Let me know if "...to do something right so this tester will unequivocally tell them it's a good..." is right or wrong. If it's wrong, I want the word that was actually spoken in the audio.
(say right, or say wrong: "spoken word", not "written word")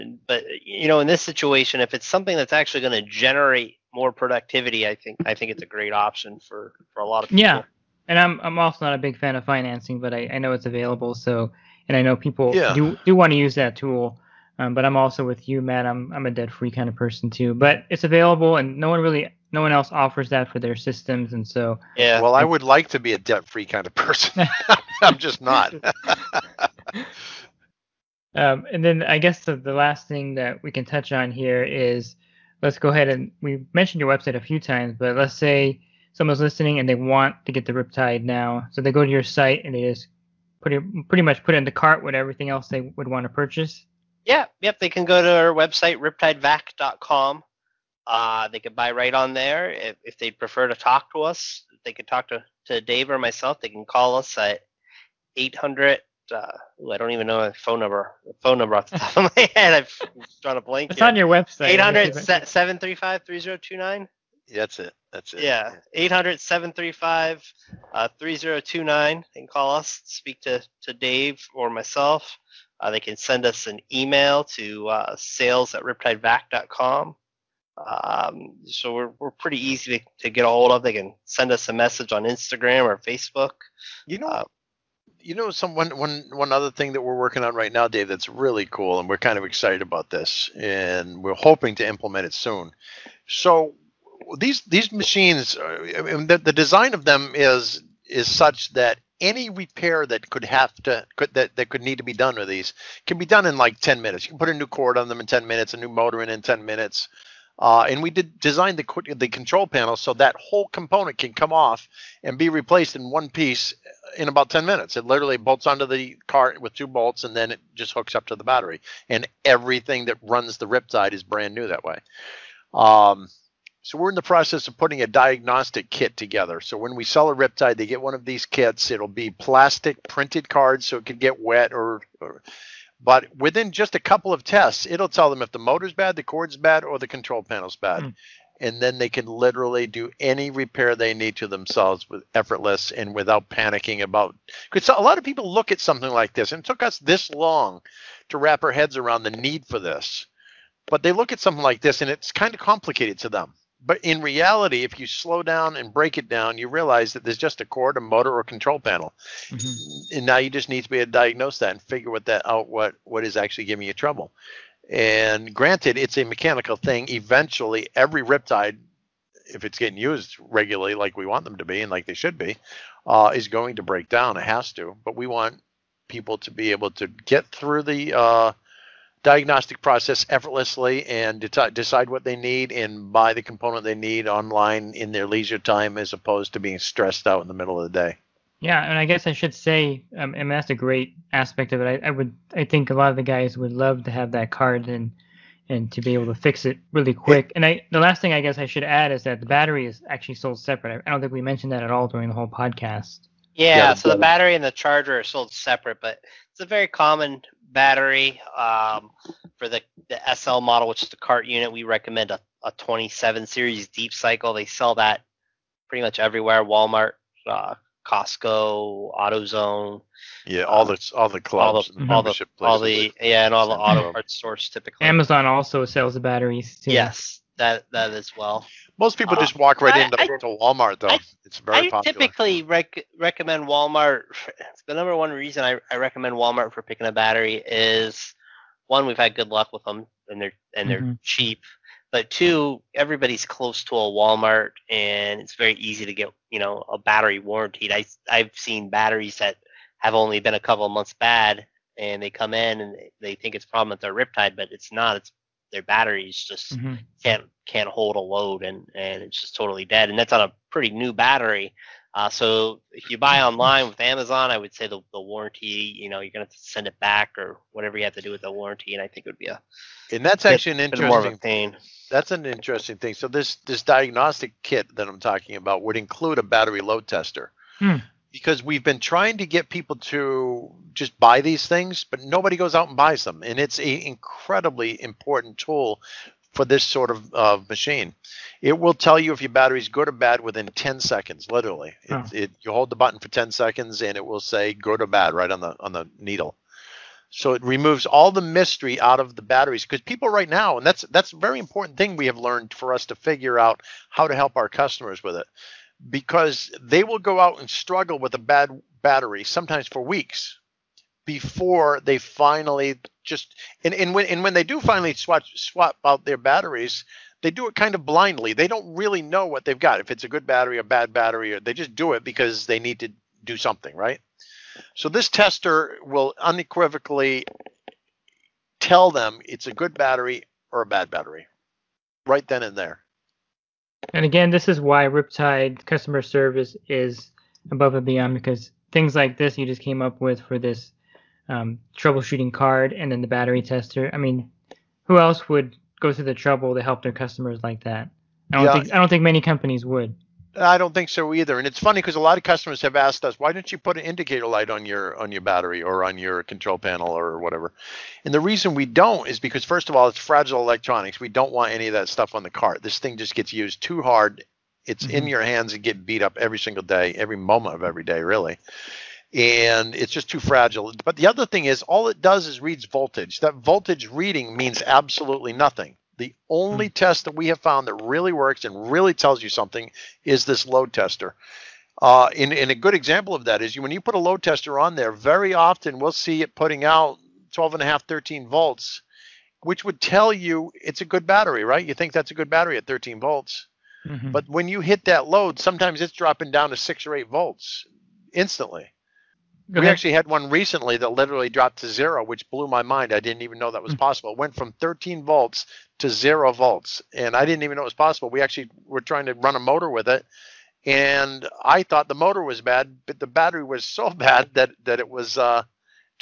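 right.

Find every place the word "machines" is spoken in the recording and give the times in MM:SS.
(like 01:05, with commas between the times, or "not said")
01:34, 04:47.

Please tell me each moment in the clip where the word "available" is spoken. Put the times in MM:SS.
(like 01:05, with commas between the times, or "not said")
00:10, 00:18.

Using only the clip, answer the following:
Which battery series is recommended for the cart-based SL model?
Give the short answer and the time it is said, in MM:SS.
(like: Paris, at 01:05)
27 series deep cycle, at 03:32.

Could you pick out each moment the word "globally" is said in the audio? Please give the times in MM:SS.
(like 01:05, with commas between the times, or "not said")
not said.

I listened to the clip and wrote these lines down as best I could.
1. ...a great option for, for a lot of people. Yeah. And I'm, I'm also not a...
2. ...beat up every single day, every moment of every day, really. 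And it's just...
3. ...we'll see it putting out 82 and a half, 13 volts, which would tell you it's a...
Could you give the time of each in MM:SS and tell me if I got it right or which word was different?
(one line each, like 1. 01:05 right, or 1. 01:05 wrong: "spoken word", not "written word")
1. 00:05 right
2. 06:06 right
3. 06:25 wrong: "12", not "82".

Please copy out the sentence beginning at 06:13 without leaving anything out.
That voltage reading means absolutely nothing the only mm.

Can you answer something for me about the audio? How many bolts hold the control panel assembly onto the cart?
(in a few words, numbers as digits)
2.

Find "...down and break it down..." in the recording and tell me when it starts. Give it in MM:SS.
02:35.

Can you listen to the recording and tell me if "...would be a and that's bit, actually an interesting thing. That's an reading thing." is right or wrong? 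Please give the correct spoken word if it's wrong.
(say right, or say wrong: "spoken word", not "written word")
wrong: "interesting", not "reading".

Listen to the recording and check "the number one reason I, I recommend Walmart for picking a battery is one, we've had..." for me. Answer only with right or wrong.
right.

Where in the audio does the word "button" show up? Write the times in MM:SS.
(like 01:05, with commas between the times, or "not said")
04:52.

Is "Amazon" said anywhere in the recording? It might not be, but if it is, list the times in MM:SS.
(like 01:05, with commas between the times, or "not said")
03:45, 04:24.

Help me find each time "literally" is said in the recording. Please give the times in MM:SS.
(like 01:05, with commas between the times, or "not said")
01:55, 02:19, 04:51, 06:41.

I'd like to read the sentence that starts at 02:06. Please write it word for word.
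So when we sell a riptide, they get one of these kits.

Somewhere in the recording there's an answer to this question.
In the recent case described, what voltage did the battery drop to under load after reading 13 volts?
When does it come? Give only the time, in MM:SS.
06:46.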